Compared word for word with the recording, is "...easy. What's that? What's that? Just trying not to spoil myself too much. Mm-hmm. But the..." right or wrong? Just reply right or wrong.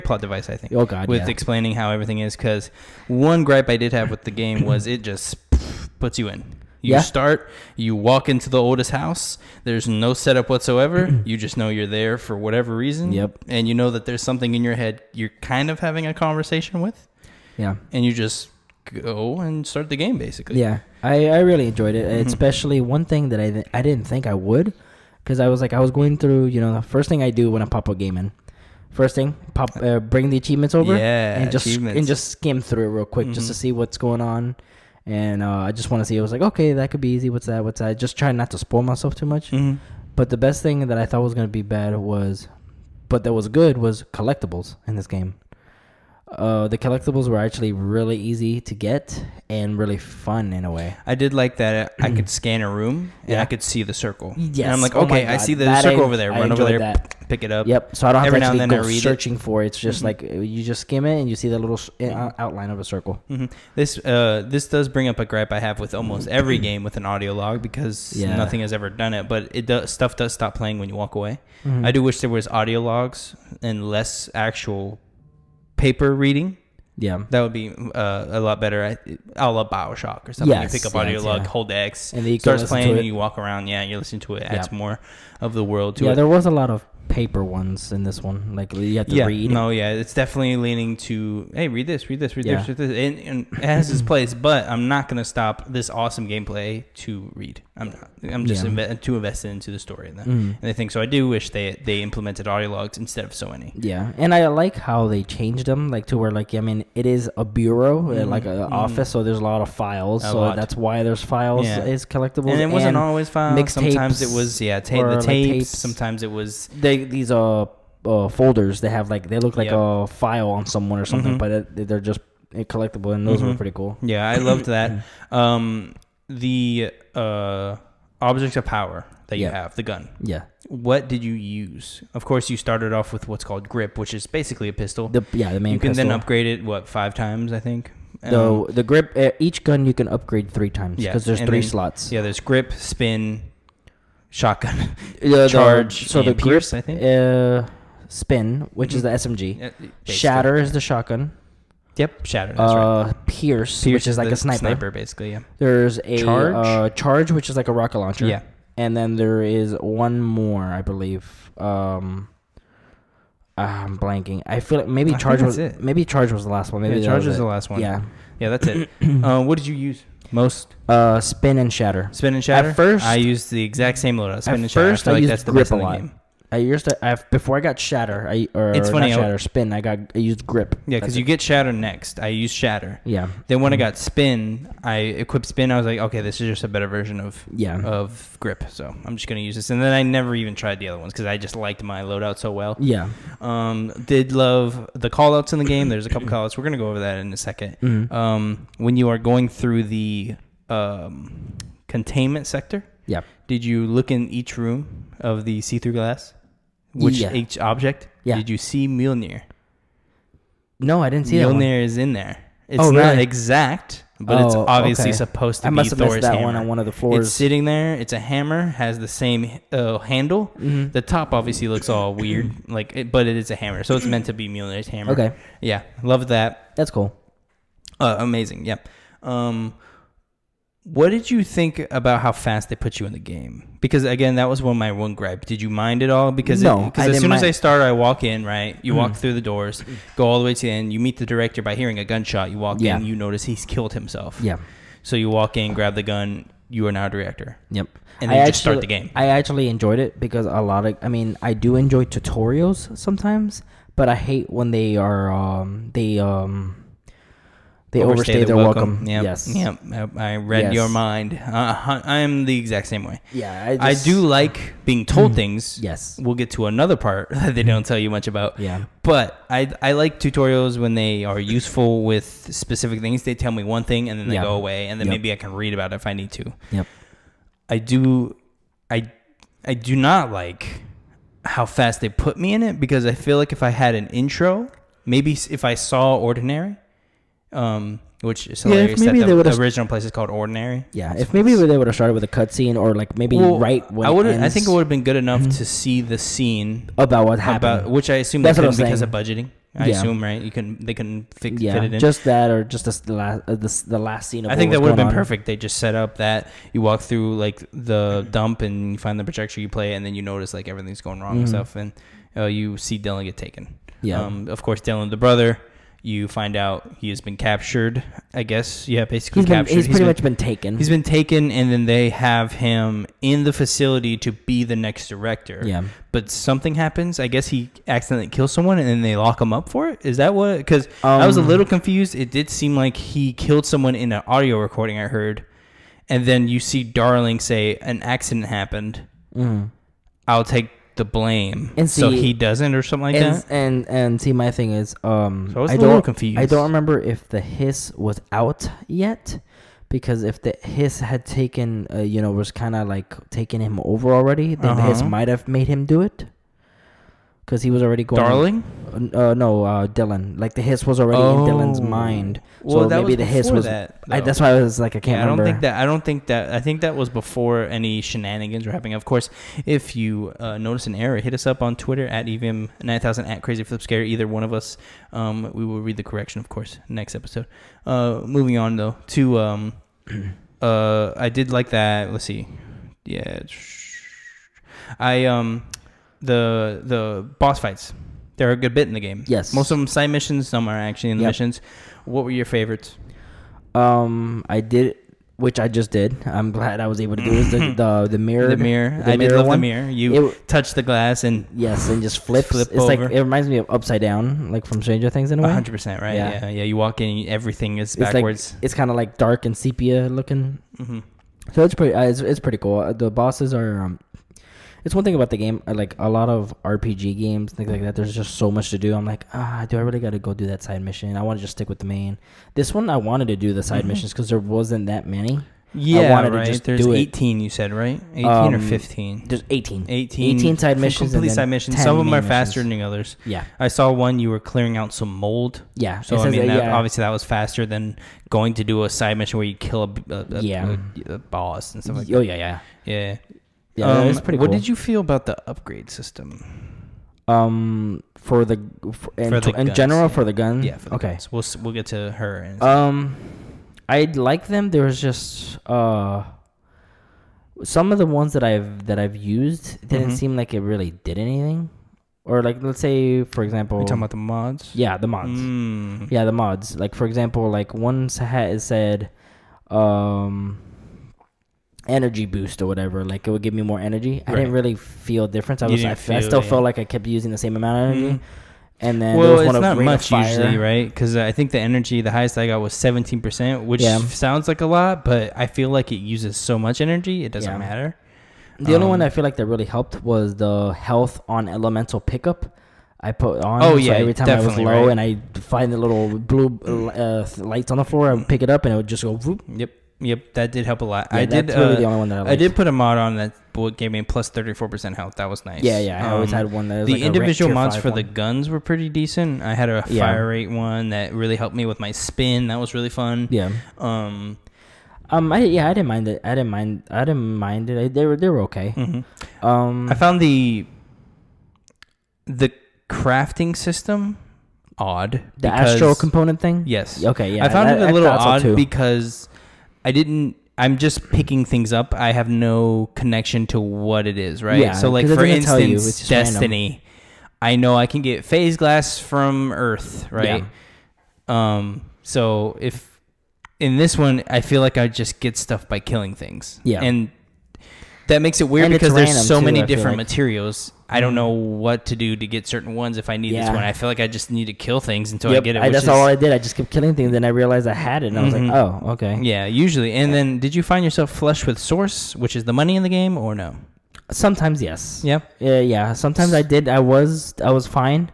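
right.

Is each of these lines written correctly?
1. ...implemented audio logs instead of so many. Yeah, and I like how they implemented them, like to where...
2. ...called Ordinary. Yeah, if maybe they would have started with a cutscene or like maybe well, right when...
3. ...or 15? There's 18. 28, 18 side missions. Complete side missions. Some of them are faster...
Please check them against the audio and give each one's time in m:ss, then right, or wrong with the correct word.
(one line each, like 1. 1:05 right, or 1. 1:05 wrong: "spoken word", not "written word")
1. 1:42 wrong: "changed", not "implemented"
2. 4:50 right
3. 7:08 wrong: "18", not "28".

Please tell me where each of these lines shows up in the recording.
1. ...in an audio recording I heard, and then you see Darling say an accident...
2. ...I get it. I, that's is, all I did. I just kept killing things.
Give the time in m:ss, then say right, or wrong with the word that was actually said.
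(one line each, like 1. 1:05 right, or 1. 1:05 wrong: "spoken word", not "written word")
1. 5:33 right
2. 9:15 right.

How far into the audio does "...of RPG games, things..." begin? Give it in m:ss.
6:56.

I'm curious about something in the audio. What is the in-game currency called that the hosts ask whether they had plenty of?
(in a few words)
Source.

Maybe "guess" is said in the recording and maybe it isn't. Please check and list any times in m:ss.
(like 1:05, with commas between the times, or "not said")
5:18, 5:27.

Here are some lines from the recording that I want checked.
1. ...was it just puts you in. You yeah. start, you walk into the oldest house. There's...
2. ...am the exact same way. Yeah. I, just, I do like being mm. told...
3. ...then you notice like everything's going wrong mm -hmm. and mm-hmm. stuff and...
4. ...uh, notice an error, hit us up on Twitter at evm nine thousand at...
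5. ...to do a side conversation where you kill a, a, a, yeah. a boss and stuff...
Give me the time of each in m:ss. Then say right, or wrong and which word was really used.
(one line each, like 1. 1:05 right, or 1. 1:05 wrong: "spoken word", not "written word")
1. 0:04 right
2. 4:22 right
3. 5:10 right
4. 6:10 right
5. 7:18 wrong: "mission", not "conversation".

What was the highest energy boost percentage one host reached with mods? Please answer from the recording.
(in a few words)
17 percent.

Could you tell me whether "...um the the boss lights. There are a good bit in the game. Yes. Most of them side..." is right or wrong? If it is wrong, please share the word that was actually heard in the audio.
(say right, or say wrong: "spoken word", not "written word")
wrong: "fights", not "lights".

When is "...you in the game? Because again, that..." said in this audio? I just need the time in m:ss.
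3:52.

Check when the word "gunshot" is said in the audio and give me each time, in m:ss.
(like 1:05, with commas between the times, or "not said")
4:02.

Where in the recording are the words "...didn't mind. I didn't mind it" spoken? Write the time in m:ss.
8:36.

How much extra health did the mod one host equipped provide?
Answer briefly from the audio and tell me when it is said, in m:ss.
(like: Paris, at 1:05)
34 percent, at 8:24.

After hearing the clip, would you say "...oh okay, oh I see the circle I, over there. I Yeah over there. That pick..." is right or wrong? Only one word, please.
wrong.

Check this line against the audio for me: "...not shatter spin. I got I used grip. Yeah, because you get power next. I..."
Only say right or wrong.
wrong.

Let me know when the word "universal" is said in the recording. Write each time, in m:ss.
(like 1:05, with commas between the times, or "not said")
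not said.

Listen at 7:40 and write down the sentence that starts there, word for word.
seem like it really did anything.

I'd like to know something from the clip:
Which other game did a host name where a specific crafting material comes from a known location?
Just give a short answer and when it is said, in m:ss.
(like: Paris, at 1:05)
Destiny, at 8:56.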